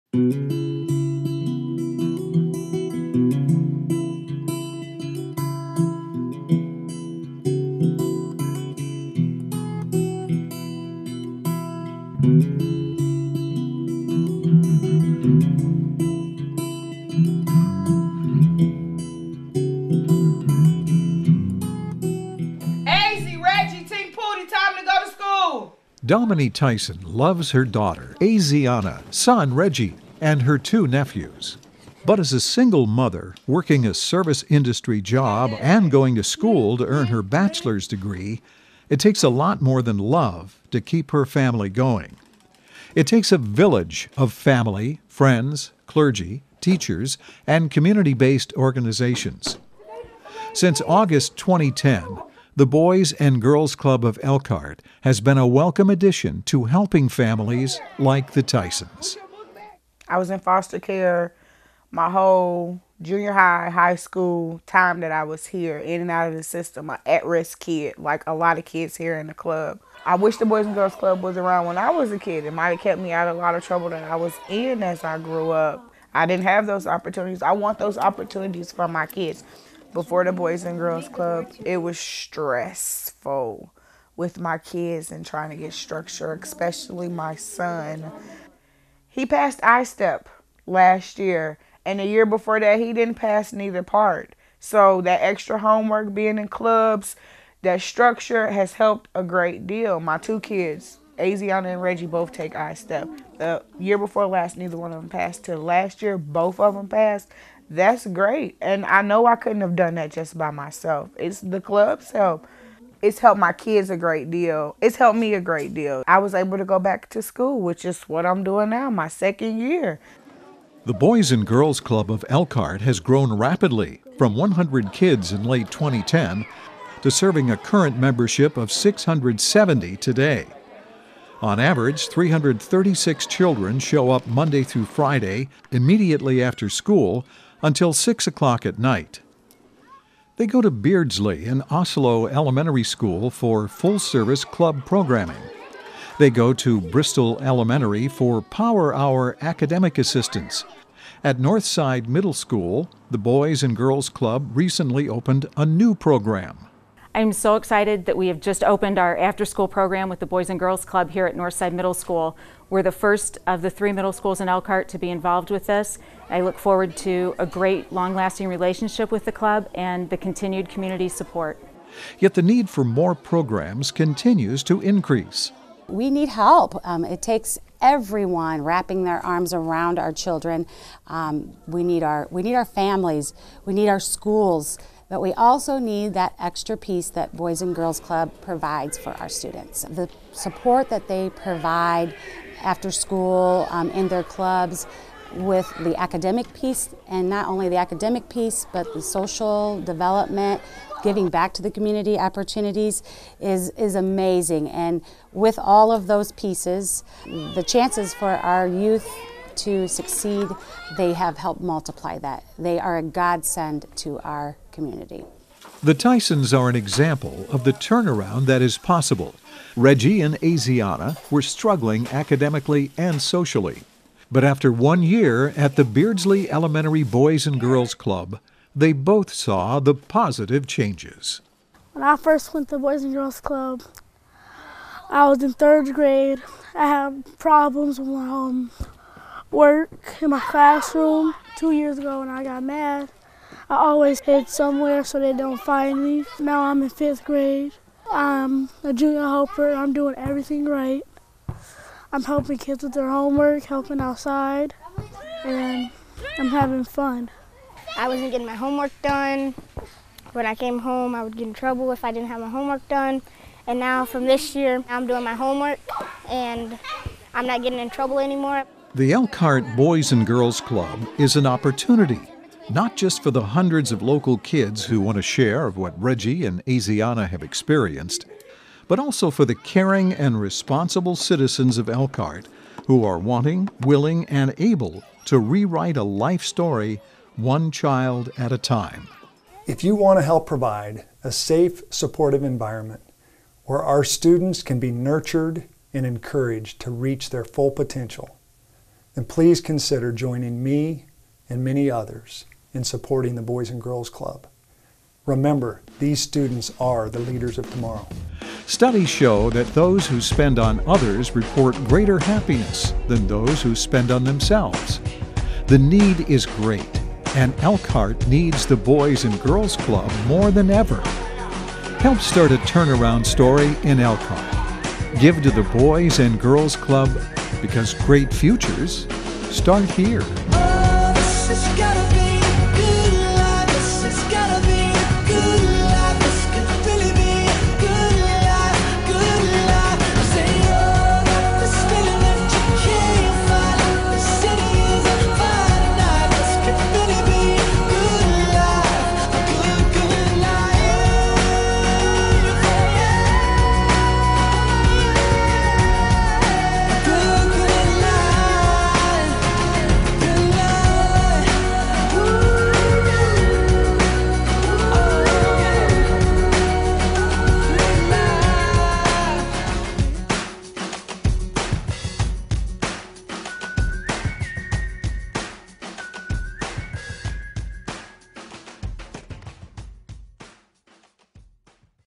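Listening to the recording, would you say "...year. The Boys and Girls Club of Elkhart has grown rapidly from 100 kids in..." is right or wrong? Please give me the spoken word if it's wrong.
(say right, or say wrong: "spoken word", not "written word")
right.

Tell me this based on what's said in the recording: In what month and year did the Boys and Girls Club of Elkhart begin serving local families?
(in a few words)
August 2010.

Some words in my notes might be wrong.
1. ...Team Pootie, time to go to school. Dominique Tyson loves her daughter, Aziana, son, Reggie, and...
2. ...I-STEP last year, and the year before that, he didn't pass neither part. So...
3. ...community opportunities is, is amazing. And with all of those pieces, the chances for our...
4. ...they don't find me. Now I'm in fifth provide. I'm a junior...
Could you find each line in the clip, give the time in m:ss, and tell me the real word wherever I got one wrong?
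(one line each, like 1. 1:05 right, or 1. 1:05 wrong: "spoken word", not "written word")
1. 0:23 right
2. 1:29 right
3. 3:21 right
4. 4:05 wrong: "grade", not "provide".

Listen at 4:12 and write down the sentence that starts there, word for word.
I'm helping kids with their homework, helping outside, and I'm having fun.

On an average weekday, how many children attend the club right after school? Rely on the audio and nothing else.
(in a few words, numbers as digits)
336.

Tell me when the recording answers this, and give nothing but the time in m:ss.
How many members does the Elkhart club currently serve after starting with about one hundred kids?
2:08.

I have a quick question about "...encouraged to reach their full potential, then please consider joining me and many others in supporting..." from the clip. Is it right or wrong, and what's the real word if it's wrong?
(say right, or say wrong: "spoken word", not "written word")
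right.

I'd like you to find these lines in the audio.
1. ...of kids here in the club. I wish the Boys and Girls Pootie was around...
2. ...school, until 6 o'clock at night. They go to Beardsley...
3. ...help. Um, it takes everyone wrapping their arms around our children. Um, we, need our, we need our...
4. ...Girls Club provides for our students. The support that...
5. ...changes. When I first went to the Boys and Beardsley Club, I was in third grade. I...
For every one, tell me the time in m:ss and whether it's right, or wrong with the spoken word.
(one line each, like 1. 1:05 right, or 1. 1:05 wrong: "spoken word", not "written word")
1. 1:08 wrong: "Club", not "Pootie"
2. 2:16 right
3. 2:56 right
4. 3:07 right
5. 3:50 wrong: "Girls", not "Beardsley".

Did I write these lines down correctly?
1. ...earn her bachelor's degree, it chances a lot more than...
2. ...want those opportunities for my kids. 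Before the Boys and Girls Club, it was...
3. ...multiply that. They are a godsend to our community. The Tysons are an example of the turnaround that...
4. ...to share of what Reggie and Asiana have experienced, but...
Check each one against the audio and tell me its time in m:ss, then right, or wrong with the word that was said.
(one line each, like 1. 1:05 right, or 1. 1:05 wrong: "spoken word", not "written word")
1. 0:36 wrong: "takes", not "chances"
2. 1:17 right
3. 3:31 right
4. 4:35 right.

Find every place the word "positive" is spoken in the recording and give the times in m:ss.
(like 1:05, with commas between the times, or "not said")
3:49.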